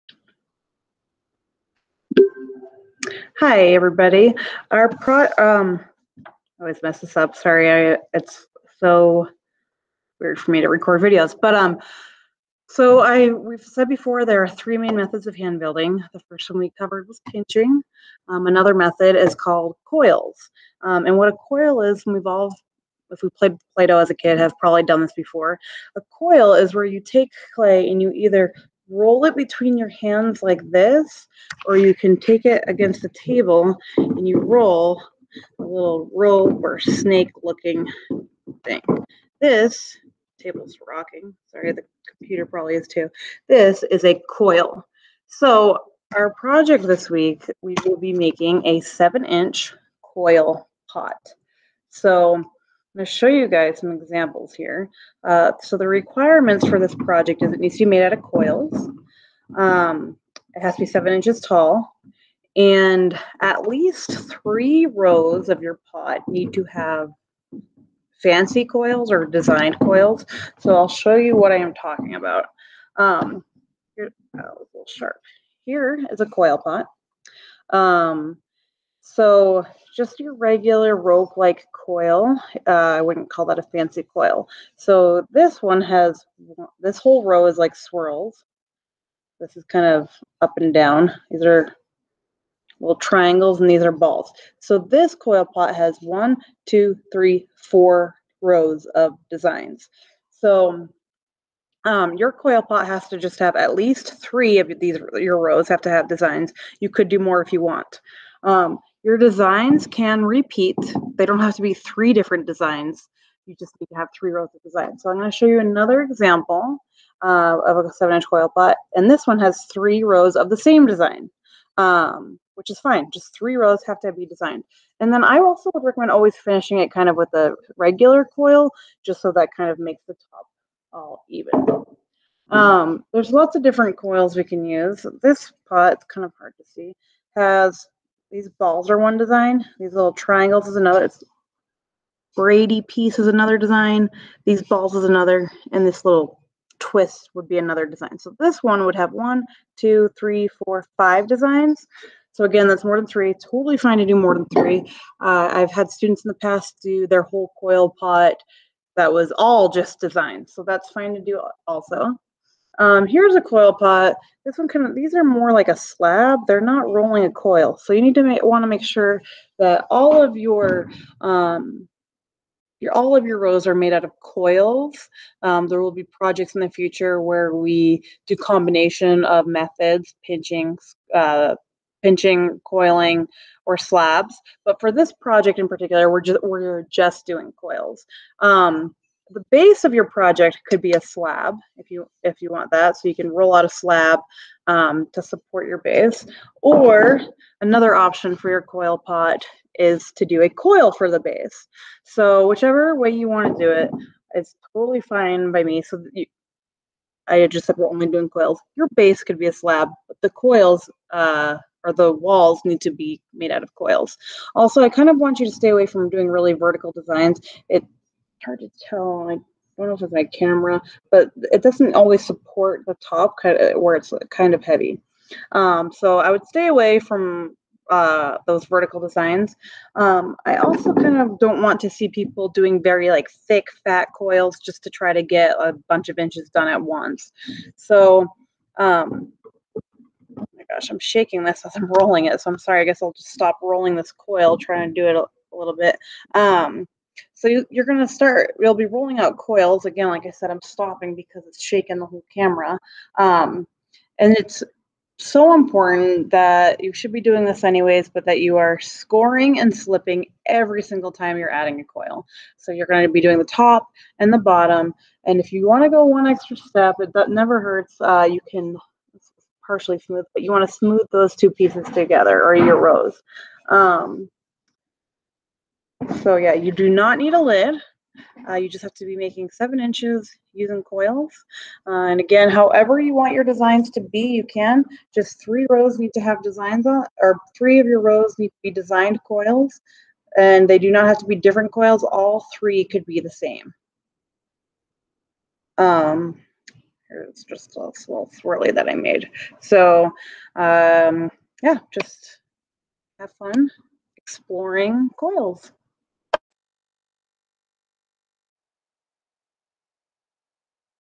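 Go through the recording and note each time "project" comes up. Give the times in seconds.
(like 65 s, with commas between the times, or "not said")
46 s, 56 s, 176 s, 185 s, 190 s.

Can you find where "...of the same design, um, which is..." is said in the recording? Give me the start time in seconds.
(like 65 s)
120 s.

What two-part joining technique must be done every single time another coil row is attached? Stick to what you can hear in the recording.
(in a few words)
scoring and slipping.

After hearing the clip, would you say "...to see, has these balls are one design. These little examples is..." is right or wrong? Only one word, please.
wrong.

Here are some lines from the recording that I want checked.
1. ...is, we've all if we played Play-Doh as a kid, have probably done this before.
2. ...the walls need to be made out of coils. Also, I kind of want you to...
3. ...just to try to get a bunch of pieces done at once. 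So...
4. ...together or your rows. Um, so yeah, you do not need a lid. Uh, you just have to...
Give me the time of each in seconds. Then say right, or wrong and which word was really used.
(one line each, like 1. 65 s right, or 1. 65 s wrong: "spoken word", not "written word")
1. 21 s right
2. 211 s right
3. 234 s wrong: "inches", not "pieces"
4. 271 s right.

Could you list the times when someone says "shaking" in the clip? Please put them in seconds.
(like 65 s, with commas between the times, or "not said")
240 s, 251 s.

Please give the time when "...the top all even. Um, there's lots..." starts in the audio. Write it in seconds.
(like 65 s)
130 s.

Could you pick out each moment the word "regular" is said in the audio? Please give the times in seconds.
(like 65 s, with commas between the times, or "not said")
80 s, 127 s.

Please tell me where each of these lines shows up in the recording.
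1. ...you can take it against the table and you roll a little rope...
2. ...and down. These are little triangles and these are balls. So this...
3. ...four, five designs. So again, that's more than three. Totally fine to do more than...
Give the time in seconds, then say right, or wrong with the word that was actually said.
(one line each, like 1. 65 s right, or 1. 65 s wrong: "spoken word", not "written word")
1. 31 s right
2. 90 s right
3. 150 s right.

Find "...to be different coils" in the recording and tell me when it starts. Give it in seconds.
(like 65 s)
291 s.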